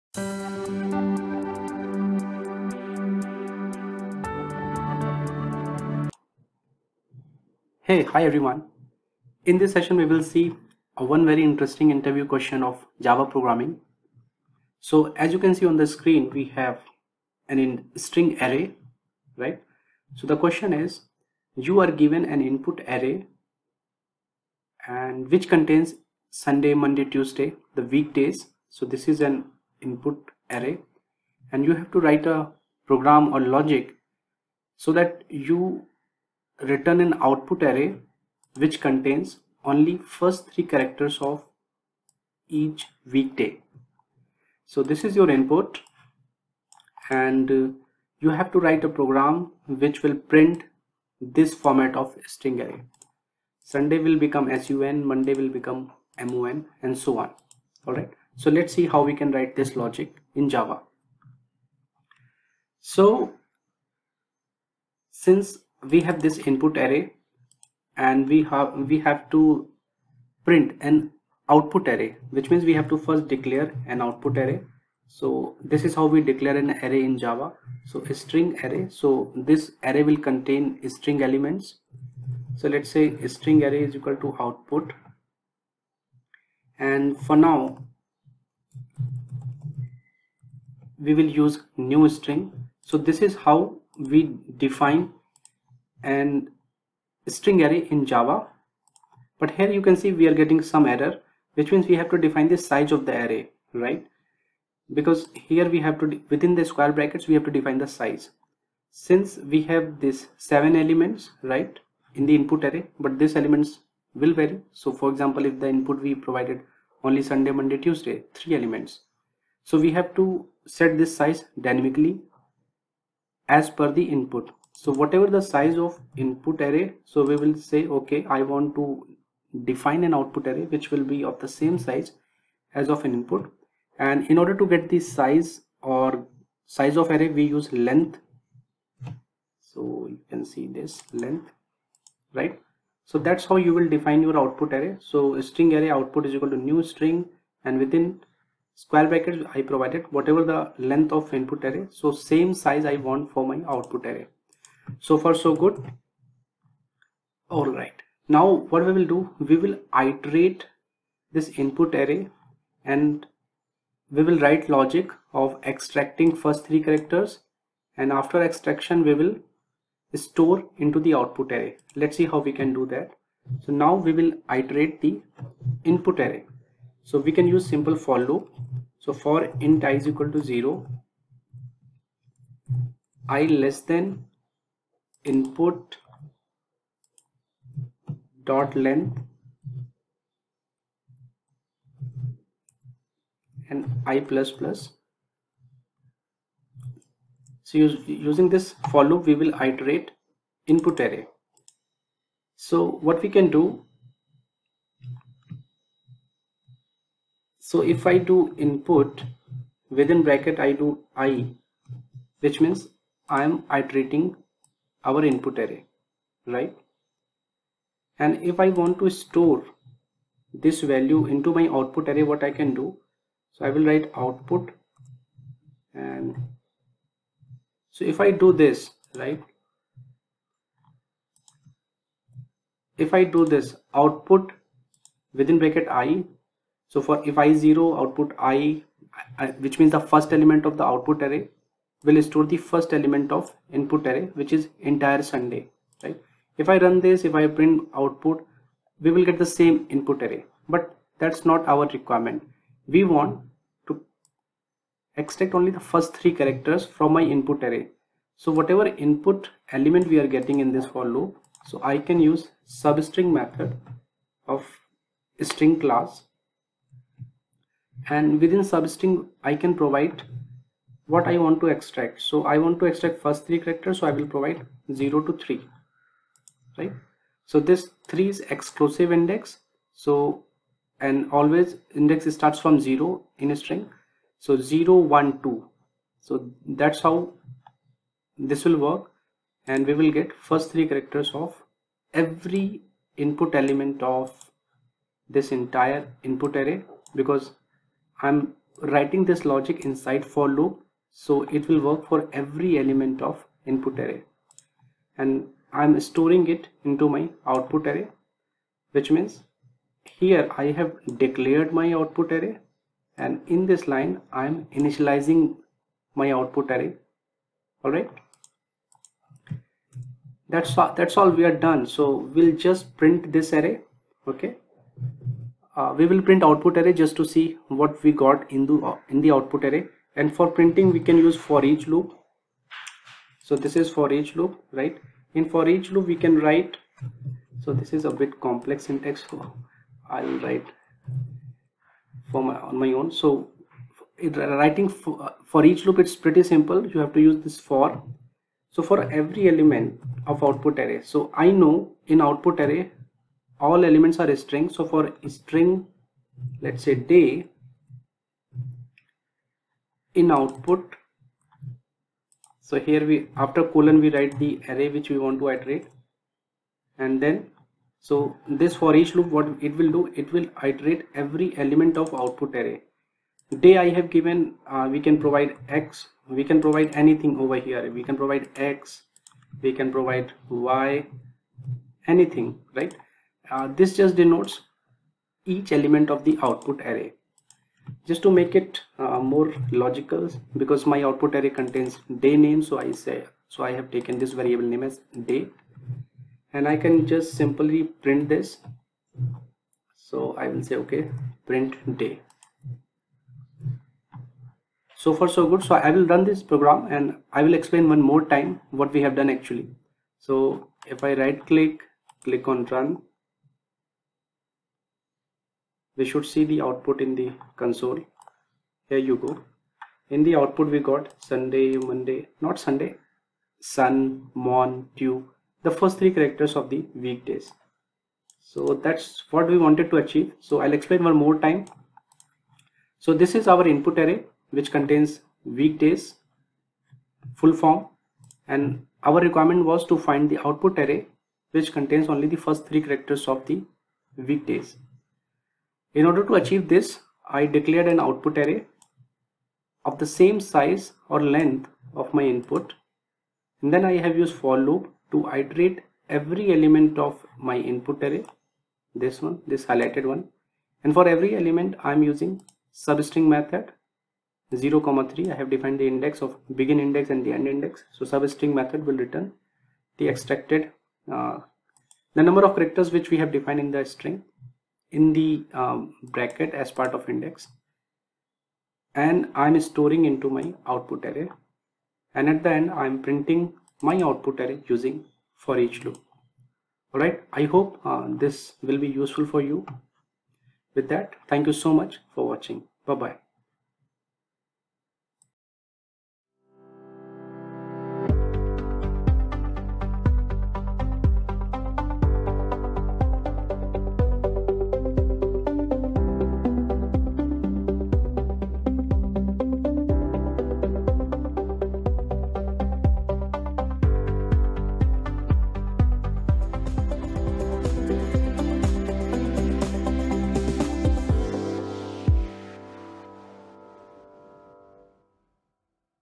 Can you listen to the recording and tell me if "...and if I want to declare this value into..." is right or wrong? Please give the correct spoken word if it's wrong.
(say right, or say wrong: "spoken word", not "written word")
wrong: "store", not "declare".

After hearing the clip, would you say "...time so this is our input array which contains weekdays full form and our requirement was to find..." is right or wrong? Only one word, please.
right.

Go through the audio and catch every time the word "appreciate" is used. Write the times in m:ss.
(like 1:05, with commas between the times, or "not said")
not said.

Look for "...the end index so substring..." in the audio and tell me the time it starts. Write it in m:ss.
7:47.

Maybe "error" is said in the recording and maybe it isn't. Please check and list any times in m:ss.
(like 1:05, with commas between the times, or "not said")
1:40.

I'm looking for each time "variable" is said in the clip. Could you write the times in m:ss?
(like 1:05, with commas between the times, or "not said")
6:34.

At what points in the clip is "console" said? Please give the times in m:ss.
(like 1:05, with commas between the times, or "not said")
6:57.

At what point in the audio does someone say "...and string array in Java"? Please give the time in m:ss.
1:36.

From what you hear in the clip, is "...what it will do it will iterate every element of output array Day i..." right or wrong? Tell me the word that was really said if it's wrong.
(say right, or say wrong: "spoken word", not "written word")
right.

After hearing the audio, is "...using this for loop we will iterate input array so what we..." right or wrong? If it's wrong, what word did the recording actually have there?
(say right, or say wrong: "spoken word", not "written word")
right.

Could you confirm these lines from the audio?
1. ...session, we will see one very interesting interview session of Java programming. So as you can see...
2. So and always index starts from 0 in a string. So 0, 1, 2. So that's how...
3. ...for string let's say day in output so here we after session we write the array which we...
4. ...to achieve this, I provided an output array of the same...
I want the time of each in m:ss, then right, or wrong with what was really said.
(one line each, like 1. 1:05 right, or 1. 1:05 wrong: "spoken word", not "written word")
1. 0:09 wrong: "question", not "session"
2. 4:40 right
3. 5:54 wrong: "colon", not "session"
4. 7:26 wrong: "declared", not "provided".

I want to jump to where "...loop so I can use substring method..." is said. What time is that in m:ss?
4:21.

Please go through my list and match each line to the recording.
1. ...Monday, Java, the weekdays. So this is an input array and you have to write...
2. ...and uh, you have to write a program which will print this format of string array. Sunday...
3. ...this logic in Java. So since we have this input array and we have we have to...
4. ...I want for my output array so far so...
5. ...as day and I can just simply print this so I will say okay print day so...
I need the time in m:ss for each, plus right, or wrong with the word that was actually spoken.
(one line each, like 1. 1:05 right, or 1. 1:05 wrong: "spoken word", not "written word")
1. 0:26 wrong: "Tuesday", not "Java"
2. 0:47 right
3. 0:59 right
4. 2:32 right
5. 6:34 right.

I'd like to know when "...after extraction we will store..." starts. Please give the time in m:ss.
2:48.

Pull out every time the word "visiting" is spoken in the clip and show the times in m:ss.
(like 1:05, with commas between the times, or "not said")
not said.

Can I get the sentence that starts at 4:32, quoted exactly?
So I want to extract first three characters.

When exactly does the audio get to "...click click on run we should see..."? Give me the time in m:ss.
6:51.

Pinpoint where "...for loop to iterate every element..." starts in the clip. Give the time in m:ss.
7:34.